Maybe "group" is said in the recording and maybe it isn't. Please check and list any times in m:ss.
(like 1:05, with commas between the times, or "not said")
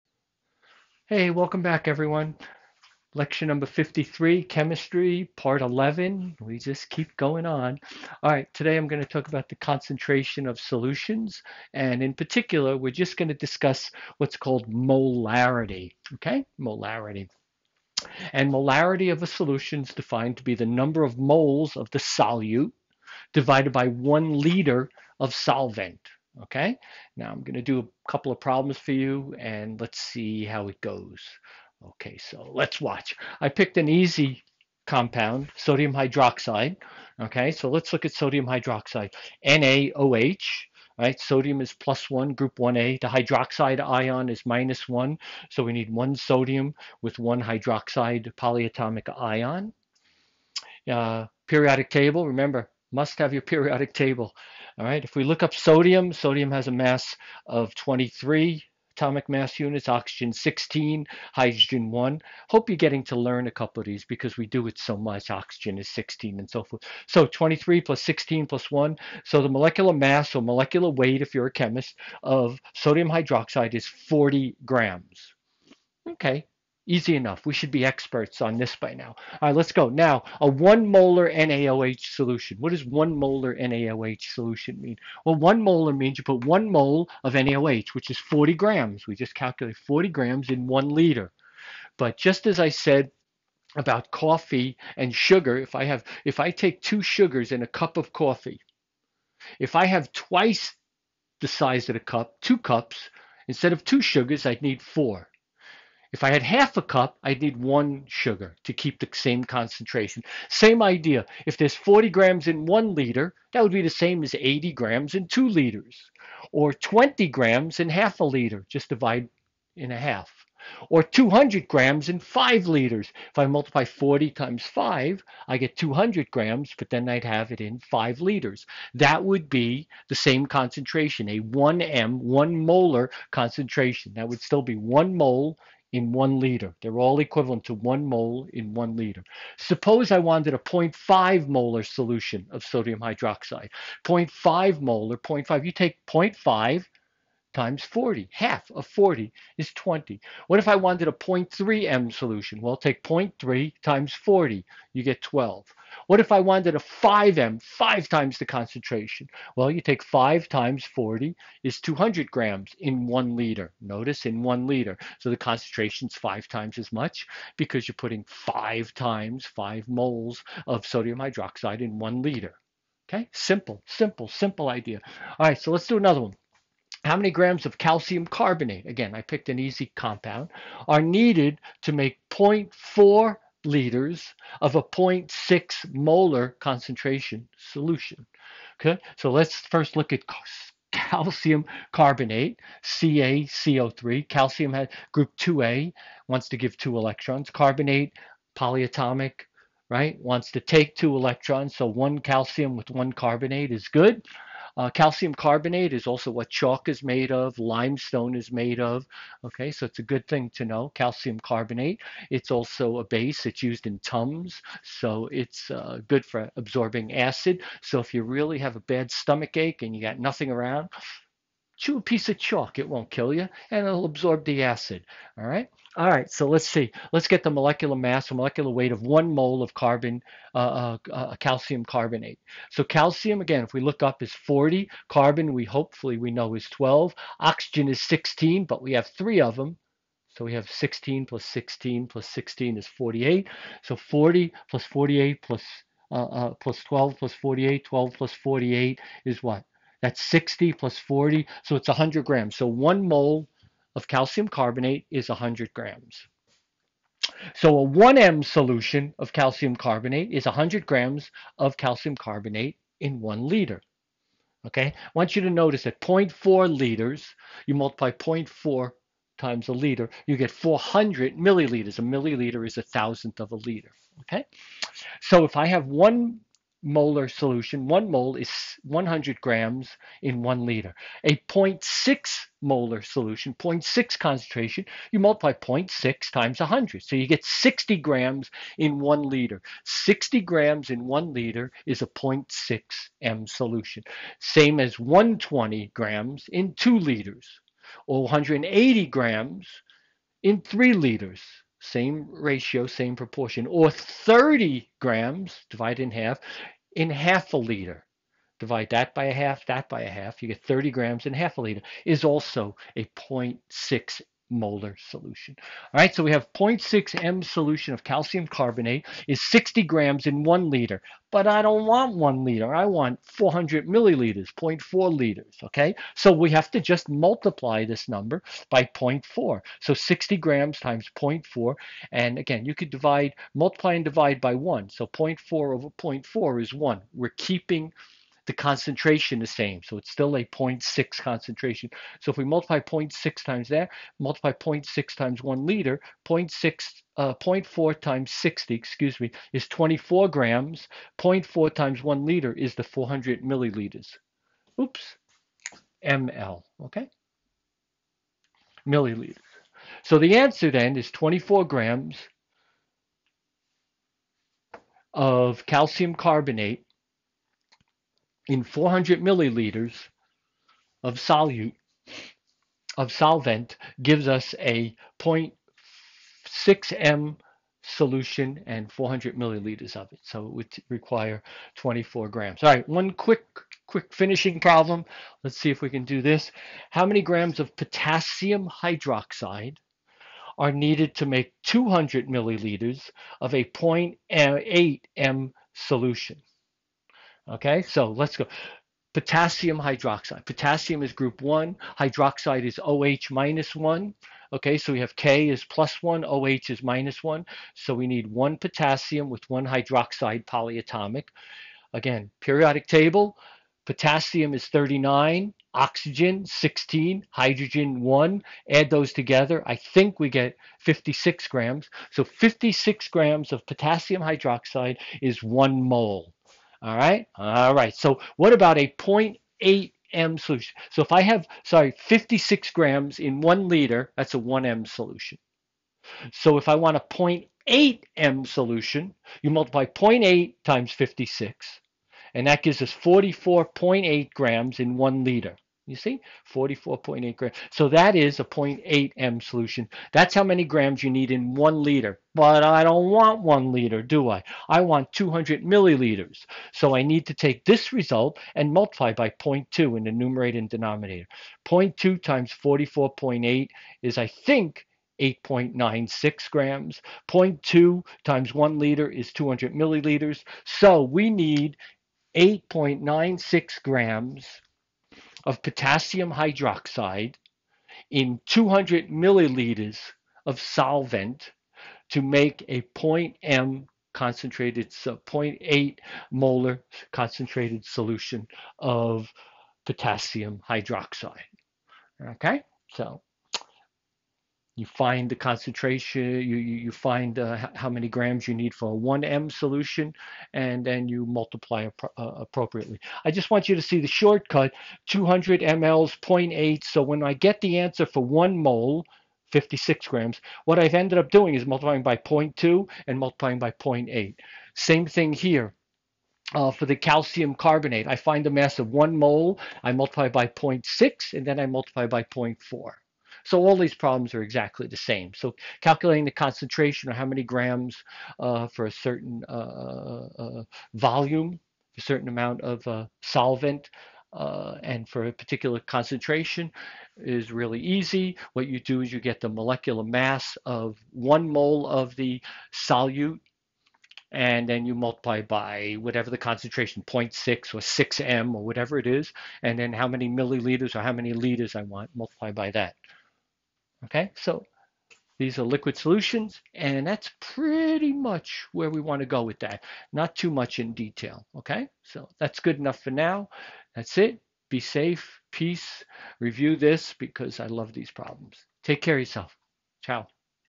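0:42, 3:15, 6:41.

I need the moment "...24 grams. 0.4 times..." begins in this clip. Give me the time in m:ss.
5:49.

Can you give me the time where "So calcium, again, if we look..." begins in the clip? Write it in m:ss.
3:52.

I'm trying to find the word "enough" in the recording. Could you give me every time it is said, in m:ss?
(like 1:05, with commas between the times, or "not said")
1:17, 9:22.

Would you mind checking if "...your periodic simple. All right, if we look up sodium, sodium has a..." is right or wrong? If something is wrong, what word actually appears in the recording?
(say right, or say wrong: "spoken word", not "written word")
wrong: "table", not "simple".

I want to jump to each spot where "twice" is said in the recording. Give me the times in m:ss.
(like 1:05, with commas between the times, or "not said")
1:40.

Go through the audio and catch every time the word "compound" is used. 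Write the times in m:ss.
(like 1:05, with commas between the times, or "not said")
0:34, 2:59.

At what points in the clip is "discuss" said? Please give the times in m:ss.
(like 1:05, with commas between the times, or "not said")
0:13.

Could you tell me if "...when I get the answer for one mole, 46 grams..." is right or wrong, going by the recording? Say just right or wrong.
wrong.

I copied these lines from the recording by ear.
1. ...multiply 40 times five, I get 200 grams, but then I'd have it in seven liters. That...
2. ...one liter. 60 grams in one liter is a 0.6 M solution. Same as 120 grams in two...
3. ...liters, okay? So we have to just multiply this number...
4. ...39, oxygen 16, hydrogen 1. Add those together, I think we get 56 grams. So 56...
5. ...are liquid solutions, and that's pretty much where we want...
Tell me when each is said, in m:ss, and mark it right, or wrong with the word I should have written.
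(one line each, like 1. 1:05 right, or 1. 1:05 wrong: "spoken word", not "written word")
1. 2:03 wrong: "five", not "seven"
2. 4:48 right
3. 5:25 right
4. 6:54 right
5. 9:15 right.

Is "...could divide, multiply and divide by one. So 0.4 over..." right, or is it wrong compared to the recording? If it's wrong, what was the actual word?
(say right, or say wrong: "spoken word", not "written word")
right.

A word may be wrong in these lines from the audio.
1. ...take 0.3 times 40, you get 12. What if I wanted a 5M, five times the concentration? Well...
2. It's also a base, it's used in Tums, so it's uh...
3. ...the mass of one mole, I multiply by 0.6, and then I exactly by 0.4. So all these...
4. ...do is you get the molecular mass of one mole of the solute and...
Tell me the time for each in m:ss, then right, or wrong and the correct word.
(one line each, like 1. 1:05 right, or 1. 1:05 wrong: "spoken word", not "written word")
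1. 2:32 right
2. 3:32 right
3. 8:38 wrong: "multiply", not "exactly"
4. 8:58 right.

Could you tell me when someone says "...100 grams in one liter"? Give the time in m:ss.
4:38.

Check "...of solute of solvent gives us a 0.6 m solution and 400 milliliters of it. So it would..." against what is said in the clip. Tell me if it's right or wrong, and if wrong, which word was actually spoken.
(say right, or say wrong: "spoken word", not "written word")
right.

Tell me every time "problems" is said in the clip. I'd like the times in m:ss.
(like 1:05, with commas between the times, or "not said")
0:28, 6:24, 8:43, 9:28.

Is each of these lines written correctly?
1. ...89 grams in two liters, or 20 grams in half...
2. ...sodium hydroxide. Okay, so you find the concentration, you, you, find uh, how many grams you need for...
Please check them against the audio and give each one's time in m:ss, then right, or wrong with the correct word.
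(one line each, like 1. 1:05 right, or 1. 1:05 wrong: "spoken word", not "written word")
1. 1:54 wrong: "80", not "89"
2. 8:09 wrong: "potassium", not "sodium".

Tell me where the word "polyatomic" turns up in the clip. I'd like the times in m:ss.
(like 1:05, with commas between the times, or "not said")
0:48, 3:18, 6:50.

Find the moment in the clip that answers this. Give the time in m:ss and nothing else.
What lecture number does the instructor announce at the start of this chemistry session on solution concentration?
0:03.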